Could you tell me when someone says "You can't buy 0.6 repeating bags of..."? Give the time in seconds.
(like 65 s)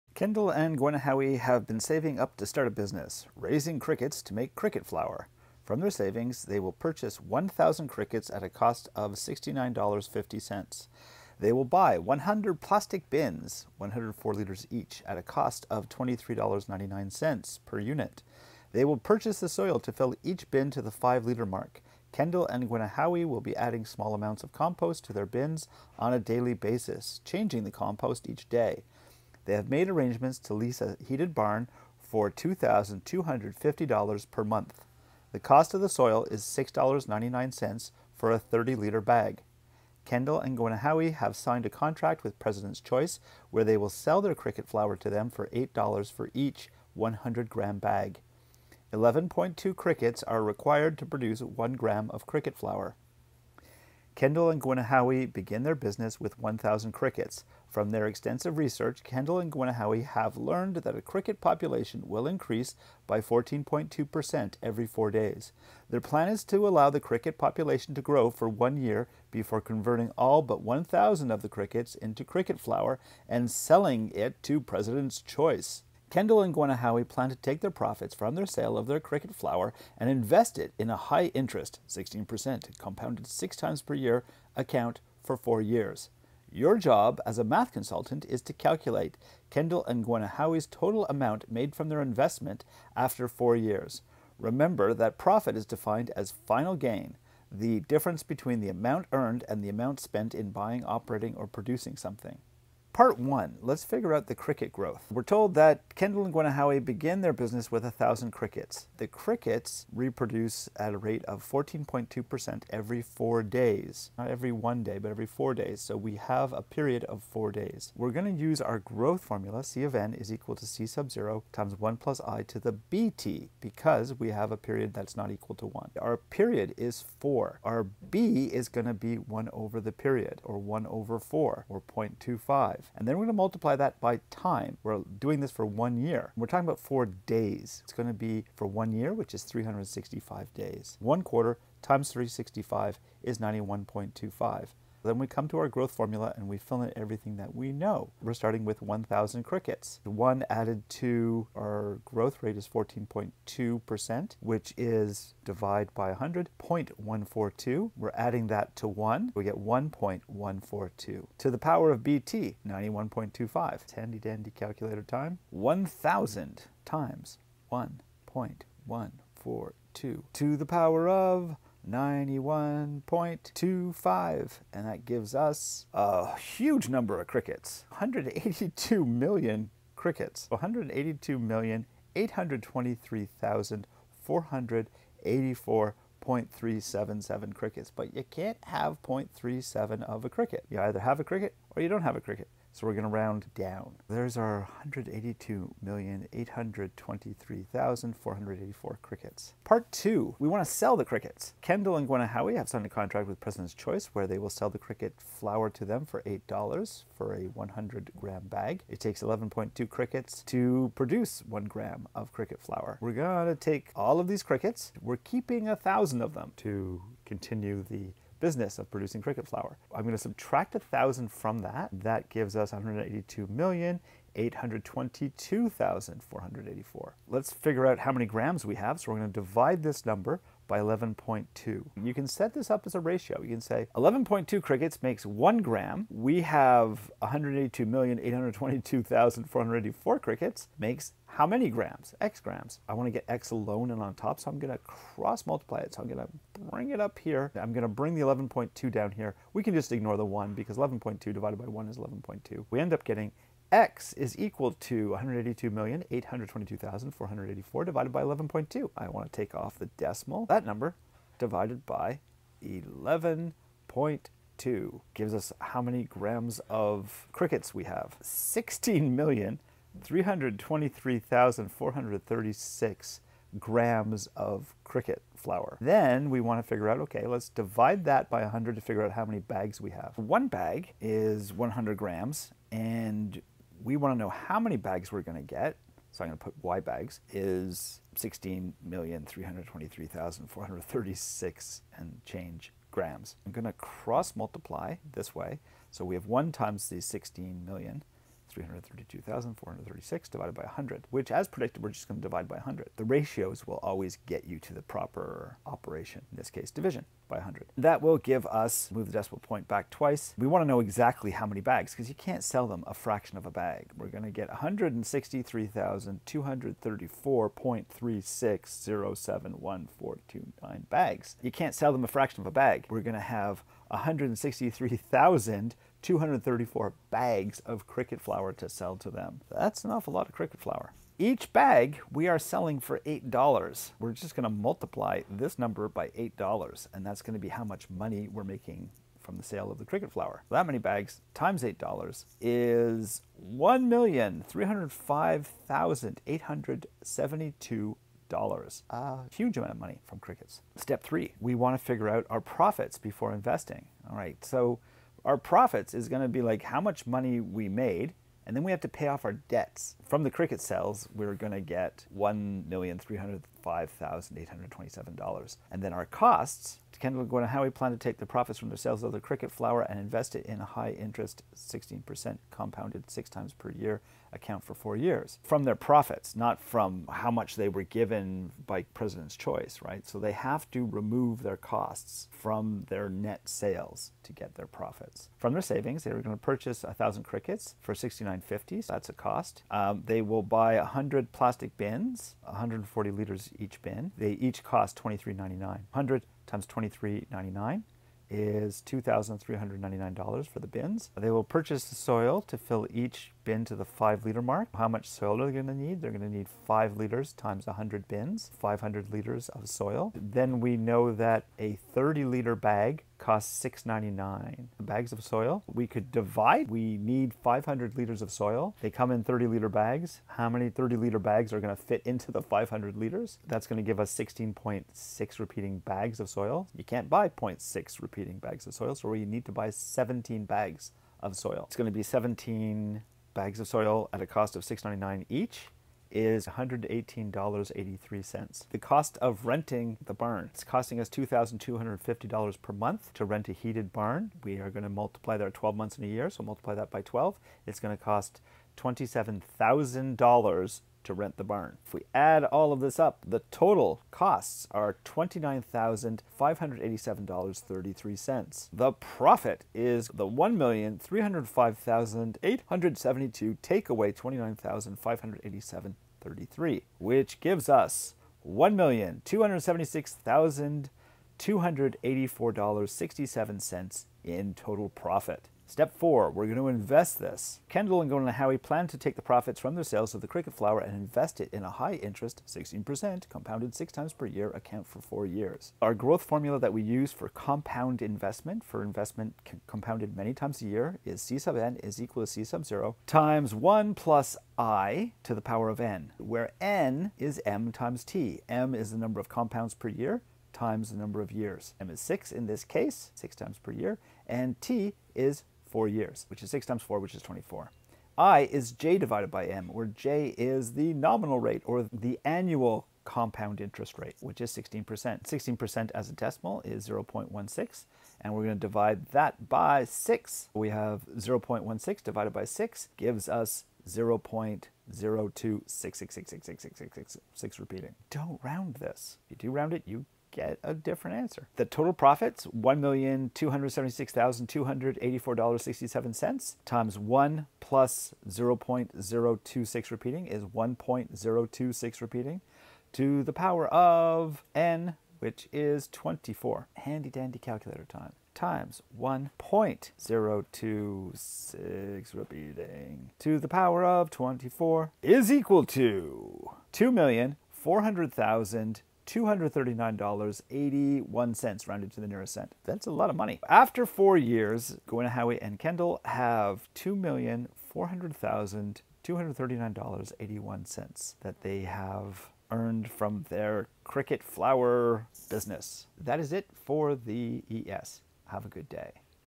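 426 s.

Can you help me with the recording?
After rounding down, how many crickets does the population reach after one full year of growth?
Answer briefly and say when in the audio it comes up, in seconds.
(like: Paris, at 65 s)
182,823,484, at 194 s.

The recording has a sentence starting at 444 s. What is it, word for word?
We are going to multiply that 12 months in a year, so multiply that by 12.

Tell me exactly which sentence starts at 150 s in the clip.
One added to our growth rate is 14.2%, which is divide by 100, 0.142.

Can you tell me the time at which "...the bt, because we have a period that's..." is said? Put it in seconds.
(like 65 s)
122 s.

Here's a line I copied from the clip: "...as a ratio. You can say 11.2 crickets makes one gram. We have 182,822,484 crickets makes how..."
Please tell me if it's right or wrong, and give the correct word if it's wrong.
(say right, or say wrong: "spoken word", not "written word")
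right.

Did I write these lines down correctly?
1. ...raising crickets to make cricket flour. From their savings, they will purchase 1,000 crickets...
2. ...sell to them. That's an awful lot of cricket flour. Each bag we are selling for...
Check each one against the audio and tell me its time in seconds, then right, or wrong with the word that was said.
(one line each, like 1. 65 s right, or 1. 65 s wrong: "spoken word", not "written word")
1. 3 s right
2. 328 s right.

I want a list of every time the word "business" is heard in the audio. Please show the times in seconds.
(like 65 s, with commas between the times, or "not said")
2 s, 55 s, 107 s, 218 s, 575 s.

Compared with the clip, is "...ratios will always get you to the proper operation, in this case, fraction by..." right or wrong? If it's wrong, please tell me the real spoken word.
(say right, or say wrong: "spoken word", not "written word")
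wrong: "division", not "fraction".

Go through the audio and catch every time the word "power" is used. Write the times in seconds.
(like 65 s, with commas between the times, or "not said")
161 s, 170 s, 495 s.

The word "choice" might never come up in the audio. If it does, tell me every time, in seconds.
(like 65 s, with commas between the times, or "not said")
42 s, 75 s, 203 s, 379 s.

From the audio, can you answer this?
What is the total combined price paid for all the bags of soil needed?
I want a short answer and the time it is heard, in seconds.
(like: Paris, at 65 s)
$118.83, at 436 s.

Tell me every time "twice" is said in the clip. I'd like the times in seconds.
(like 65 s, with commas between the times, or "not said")
309 s.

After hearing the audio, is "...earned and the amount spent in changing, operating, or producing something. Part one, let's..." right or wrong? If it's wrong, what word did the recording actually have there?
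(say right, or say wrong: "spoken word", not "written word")
wrong: "buying", not "changing".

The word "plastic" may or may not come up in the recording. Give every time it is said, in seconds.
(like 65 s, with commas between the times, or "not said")
12 s, 391 s.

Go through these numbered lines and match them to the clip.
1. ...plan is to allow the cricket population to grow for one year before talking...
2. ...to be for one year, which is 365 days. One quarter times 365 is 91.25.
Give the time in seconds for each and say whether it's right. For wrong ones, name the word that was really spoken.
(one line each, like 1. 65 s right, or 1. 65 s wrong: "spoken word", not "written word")
1. 66 s wrong: "converting", not "talking"
2. 138 s right.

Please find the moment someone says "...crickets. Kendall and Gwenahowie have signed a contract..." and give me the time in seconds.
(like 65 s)
201 s.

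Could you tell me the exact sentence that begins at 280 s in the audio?
One bag is 100 grams and we want to know how many bags we're going to get.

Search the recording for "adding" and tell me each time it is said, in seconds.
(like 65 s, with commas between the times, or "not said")
23 s, 158 s.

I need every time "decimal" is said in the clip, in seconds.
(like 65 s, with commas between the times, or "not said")
259 s, 309 s, 516 s.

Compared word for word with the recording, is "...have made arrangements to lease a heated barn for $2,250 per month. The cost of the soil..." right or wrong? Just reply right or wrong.
right.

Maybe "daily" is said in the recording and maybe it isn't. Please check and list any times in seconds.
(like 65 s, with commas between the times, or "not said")
26 s.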